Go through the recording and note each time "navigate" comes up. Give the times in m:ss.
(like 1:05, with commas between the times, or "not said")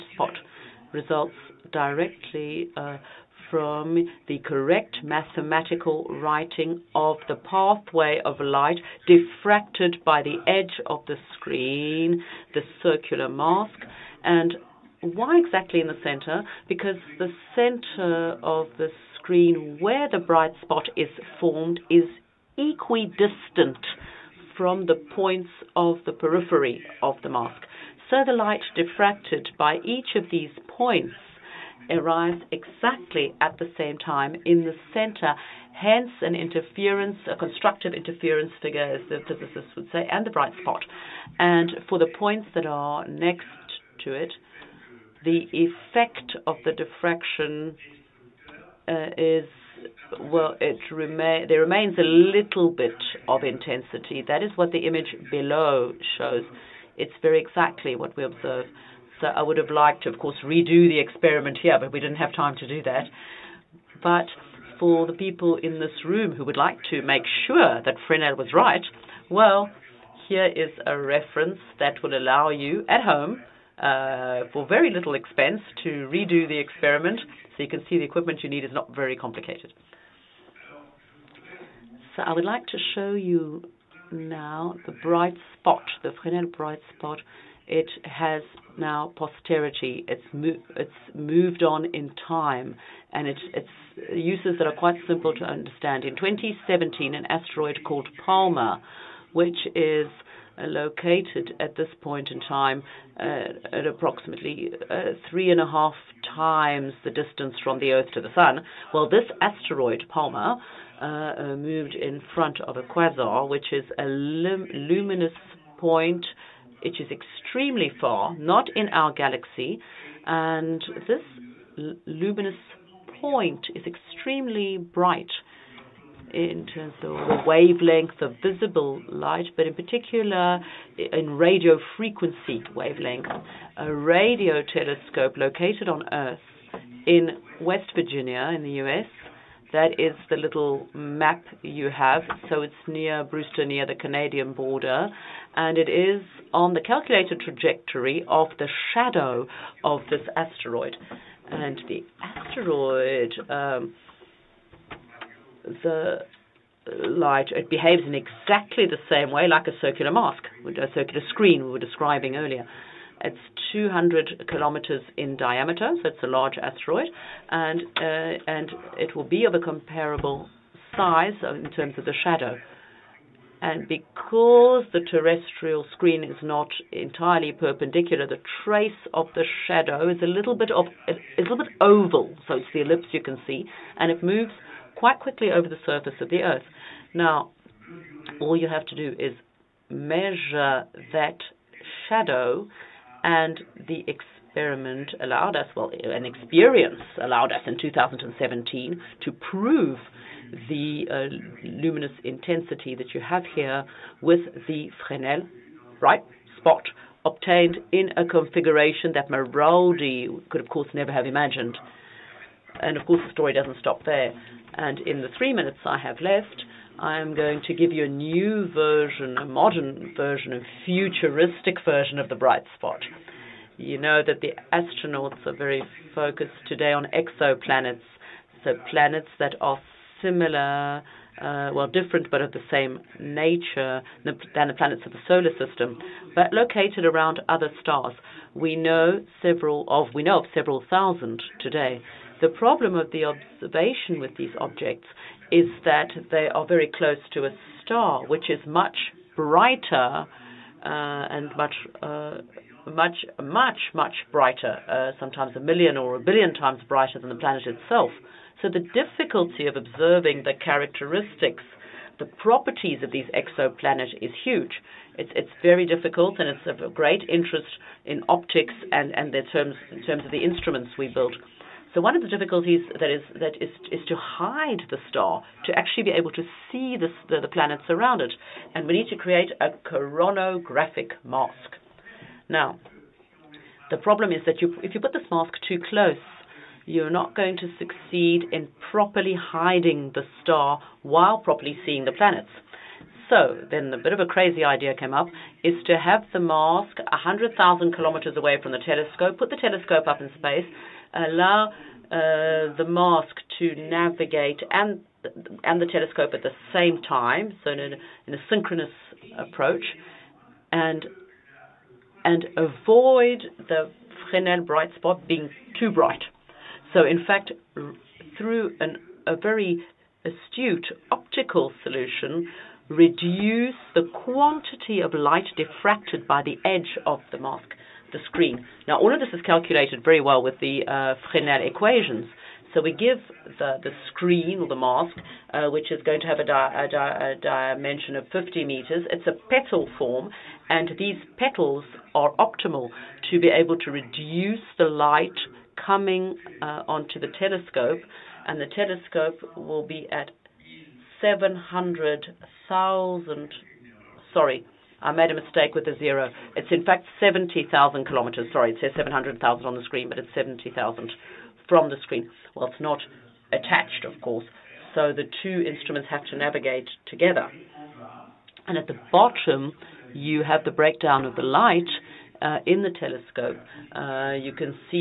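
5:03, 6:06.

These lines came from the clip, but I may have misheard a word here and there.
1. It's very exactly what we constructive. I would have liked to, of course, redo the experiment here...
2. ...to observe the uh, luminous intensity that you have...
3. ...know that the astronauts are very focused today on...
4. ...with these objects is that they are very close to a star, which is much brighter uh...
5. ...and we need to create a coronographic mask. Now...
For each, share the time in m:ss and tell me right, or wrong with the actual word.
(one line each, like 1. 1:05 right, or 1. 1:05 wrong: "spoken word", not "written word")
1. 0:56 wrong: "observe", not "constructive"
2. 3:19 wrong: "prove", not "observe"
3. 3:43 right
4. 4:04 right
5. 4:38 right.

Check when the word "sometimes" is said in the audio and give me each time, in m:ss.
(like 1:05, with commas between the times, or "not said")
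4:15.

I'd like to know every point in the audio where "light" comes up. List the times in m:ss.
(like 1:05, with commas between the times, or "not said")
0:08, 0:28, 2:09, 2:36, 5:25, 5:44, 6:11.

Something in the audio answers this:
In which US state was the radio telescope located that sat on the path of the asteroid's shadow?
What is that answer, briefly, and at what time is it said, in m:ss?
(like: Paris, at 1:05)
West Virginia, at 2:17.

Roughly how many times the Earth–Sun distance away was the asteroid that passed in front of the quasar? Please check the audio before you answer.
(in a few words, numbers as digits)
3.5.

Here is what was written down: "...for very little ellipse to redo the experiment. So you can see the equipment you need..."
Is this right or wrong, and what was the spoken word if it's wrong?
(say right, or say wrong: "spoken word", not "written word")
wrong: "expense", not "ellipse".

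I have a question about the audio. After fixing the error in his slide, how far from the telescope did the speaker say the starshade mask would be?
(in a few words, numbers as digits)
70,000 kilometers.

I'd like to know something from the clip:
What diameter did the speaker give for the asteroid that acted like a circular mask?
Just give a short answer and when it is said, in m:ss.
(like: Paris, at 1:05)
200 kilometers, at 2:43.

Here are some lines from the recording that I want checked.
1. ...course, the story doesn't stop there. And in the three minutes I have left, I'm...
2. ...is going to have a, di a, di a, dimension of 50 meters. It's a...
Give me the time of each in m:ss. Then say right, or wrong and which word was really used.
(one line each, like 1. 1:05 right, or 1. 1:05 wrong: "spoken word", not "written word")
1. 3:33 right
2. 5:35 right.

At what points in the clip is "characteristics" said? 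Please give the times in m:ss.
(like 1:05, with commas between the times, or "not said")
4:20.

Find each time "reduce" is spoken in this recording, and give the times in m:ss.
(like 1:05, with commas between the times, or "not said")
5:22, 5:43.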